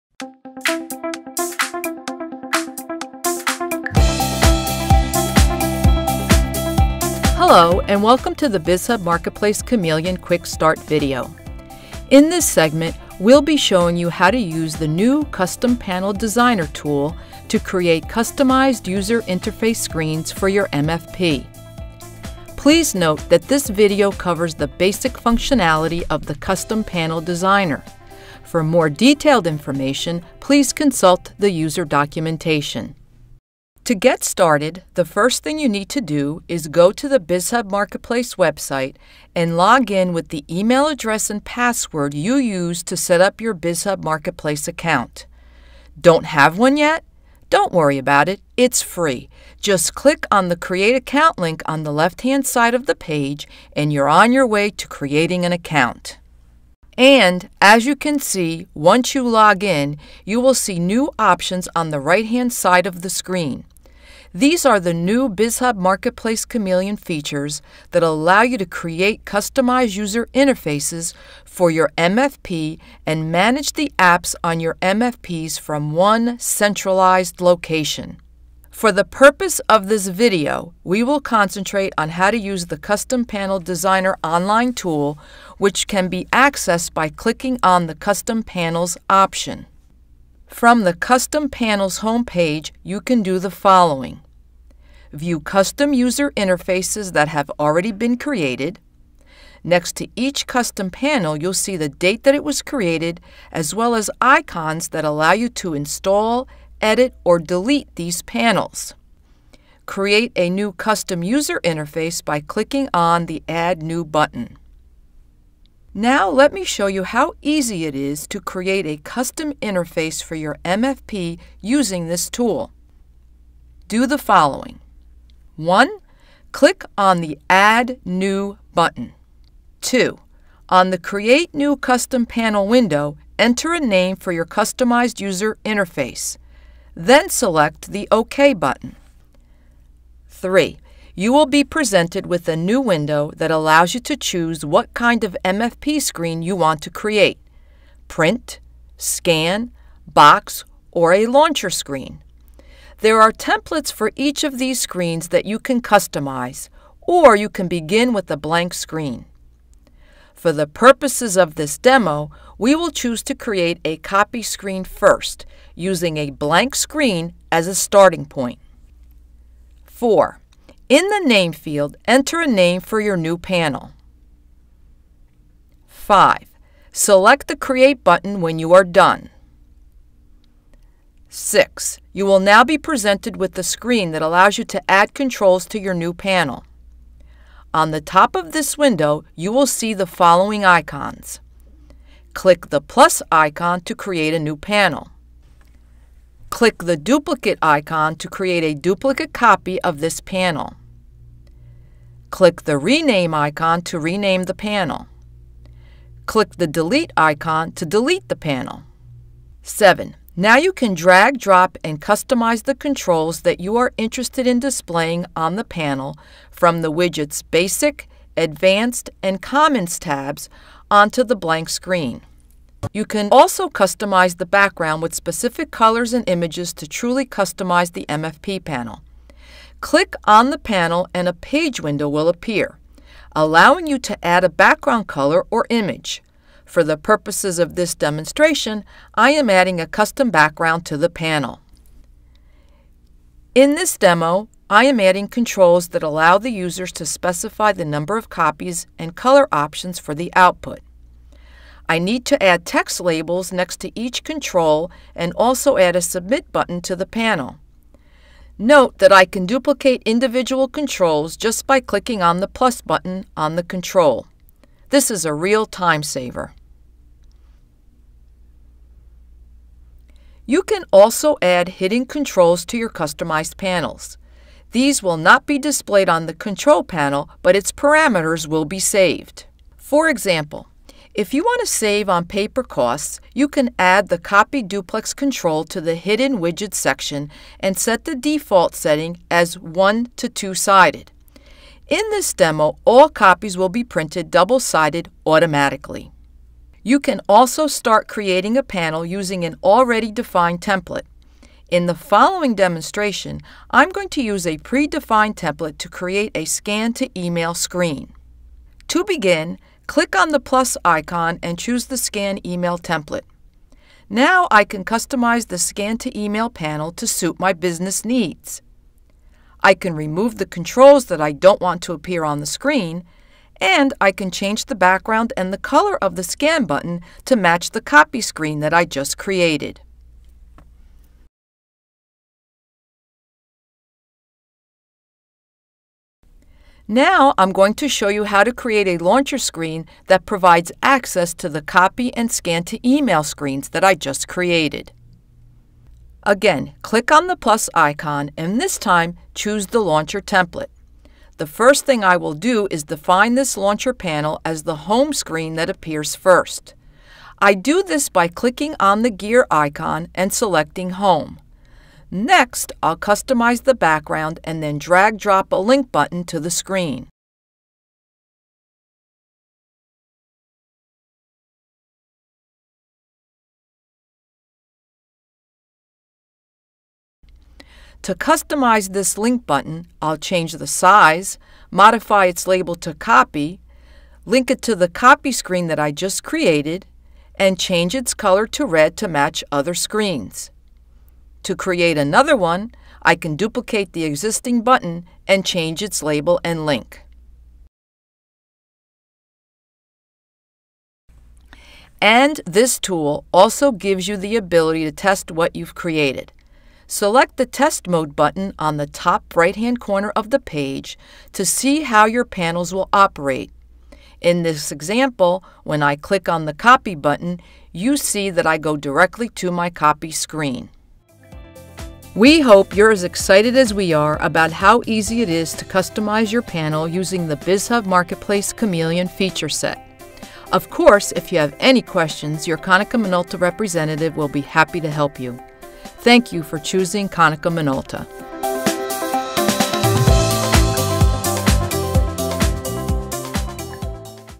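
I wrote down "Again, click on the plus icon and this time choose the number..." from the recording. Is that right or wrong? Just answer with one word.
wrong.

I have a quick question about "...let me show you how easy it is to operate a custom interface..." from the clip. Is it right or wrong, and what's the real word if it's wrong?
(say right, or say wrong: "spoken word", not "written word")
wrong: "create", not "operate".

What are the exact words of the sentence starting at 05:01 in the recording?
In the following demonstration, I'm going to use a predefined template to create a scan to email screen.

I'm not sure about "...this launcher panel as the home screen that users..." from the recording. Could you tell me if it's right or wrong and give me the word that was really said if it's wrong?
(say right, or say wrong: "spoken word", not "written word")
wrong: "appears", not "users".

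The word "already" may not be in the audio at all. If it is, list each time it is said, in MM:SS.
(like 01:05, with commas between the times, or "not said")
01:37, 04:59.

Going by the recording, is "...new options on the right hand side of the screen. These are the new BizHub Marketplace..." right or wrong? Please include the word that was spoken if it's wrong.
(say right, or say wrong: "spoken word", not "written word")
right.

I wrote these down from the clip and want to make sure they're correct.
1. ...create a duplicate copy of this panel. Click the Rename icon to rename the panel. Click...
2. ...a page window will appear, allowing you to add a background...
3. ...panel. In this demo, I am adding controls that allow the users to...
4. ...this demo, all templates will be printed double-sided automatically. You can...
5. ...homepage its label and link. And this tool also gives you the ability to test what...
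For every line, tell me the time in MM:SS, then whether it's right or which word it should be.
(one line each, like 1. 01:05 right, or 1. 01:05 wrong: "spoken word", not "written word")
1. 03:18 right
2. 03:51 right
3. 04:01 right
4. 04:52 wrong: "copies", not "templates"
5. 06:35 wrong: "change", not "homepage".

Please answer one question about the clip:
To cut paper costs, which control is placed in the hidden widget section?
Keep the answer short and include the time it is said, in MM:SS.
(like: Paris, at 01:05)
Copy Duplex, at 04:44.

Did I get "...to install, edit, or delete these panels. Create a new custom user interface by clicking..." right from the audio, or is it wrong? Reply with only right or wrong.
right.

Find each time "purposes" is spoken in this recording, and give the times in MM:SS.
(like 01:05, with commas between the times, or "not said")
01:19, 02:40, 03:56.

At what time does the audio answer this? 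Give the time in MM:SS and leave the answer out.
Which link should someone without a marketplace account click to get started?
00:50.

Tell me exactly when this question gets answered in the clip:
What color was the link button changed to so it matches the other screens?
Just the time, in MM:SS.
06:28.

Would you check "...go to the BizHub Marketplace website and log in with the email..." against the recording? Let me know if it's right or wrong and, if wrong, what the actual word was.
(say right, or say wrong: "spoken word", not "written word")
right.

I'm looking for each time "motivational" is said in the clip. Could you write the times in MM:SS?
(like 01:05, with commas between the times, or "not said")
not said.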